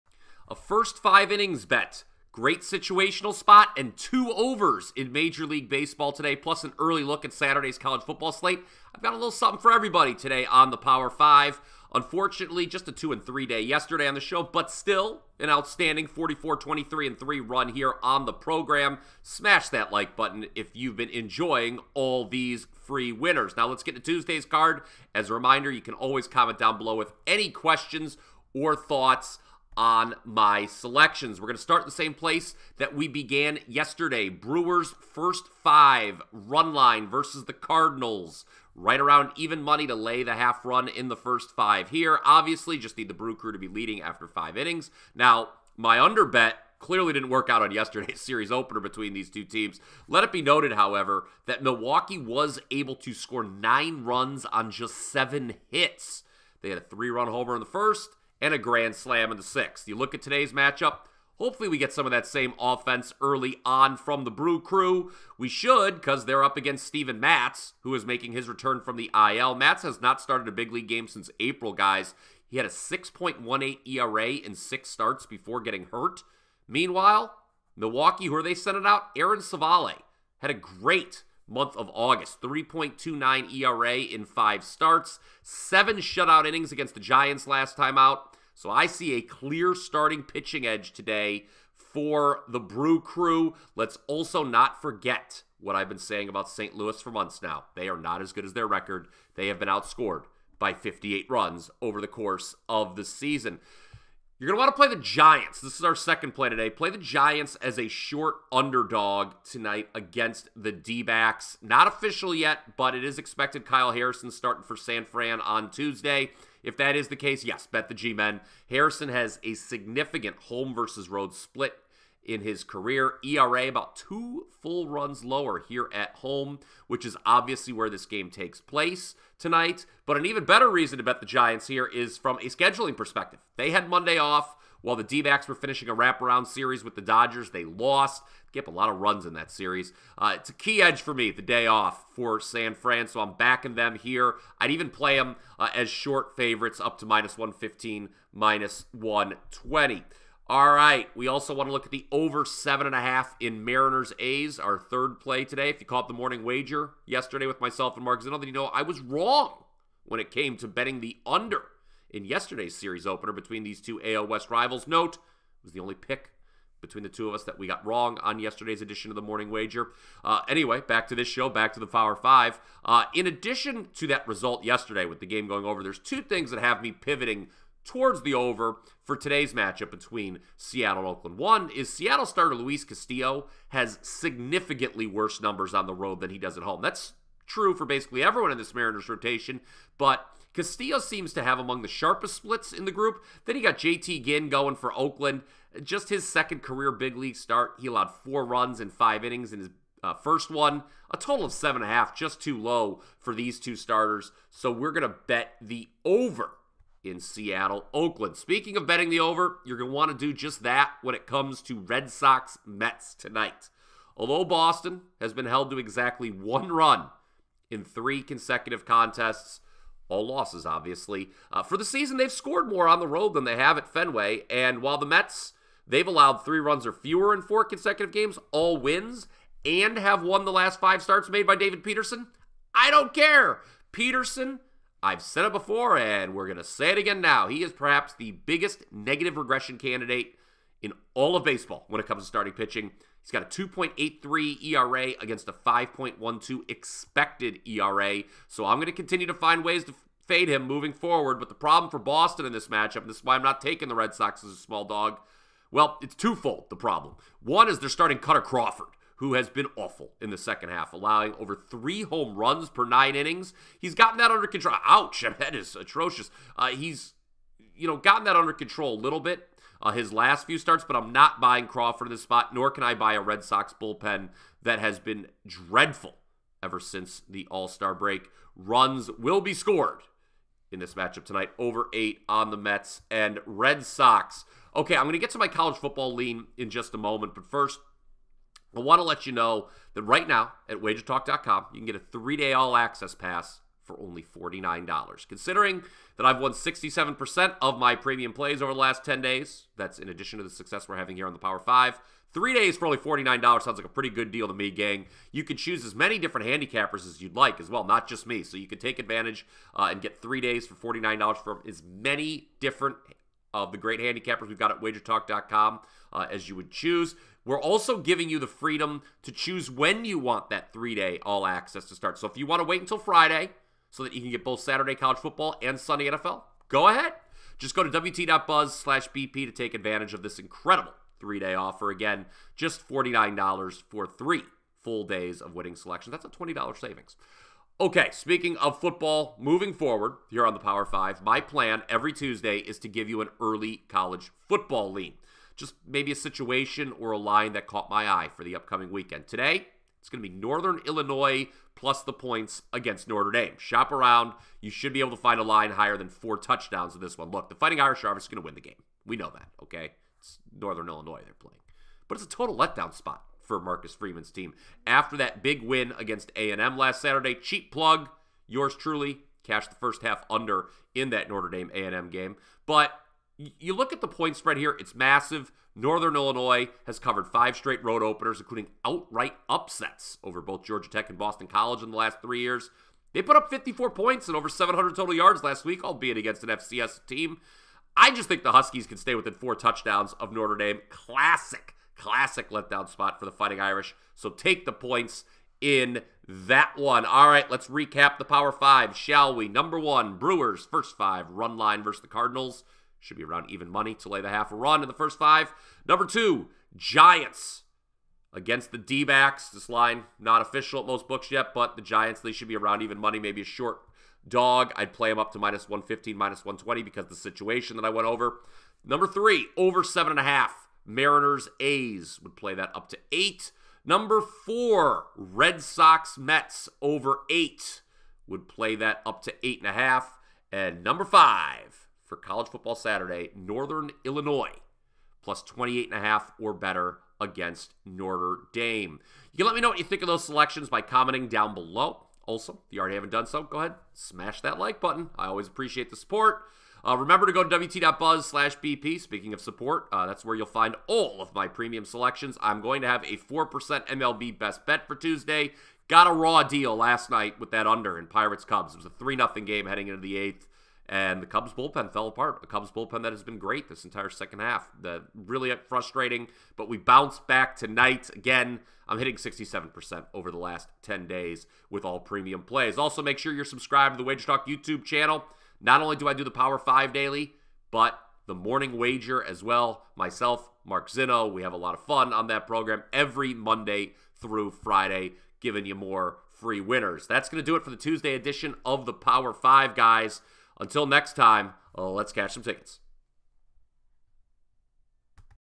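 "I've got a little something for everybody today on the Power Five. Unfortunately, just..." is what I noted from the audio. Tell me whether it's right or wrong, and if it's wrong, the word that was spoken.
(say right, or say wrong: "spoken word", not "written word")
right.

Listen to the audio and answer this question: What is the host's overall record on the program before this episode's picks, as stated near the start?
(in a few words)
44-23-3.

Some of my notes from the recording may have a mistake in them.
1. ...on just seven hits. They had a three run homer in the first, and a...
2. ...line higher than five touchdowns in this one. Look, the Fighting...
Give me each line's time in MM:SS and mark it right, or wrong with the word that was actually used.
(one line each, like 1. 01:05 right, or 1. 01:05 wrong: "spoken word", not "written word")
1. 00:54 right
2. 05:55 wrong: "four", not "five".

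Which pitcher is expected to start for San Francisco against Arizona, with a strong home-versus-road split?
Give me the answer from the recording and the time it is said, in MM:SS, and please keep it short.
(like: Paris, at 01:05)
Kyle Harrison, at 01:53.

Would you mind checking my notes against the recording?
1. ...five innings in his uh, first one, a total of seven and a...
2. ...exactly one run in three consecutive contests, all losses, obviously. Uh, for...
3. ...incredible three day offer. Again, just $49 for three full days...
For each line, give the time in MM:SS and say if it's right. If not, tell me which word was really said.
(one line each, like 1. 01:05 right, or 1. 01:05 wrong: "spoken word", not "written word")
1. 03:18 right
2. 03:35 right
3. 05:30 right.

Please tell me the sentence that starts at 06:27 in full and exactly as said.
I just think the Huskies can stay within four touchdowns of Notre Dame.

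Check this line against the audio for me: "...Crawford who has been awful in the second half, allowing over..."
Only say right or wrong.
right.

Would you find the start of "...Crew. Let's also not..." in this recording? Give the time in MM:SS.
01:33.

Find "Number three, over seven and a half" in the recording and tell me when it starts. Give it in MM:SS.
06:58.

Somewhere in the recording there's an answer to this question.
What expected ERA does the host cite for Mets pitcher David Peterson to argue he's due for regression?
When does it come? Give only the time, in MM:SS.
04:05.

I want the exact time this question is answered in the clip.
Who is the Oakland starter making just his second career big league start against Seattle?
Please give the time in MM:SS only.
03:13.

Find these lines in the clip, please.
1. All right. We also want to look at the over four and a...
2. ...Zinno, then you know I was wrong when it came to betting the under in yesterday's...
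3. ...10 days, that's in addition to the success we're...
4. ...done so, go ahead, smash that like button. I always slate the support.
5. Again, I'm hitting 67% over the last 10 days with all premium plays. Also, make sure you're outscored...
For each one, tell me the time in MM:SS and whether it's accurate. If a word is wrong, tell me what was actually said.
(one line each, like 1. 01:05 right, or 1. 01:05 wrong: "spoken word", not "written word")
1. 02:30 wrong: "seven", not "four"
2. 02:38 right
3. 04:59 right
4. 07:23 wrong: "appreciate", not "slate"
5. 07:48 wrong: "subscribed", not "outscored".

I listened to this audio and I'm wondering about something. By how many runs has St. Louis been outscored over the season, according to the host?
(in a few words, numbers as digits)
58.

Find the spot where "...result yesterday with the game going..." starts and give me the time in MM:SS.
02:54.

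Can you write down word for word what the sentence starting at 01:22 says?
3.29 ERA in five starts, seven shutout innings against the Giants last time out.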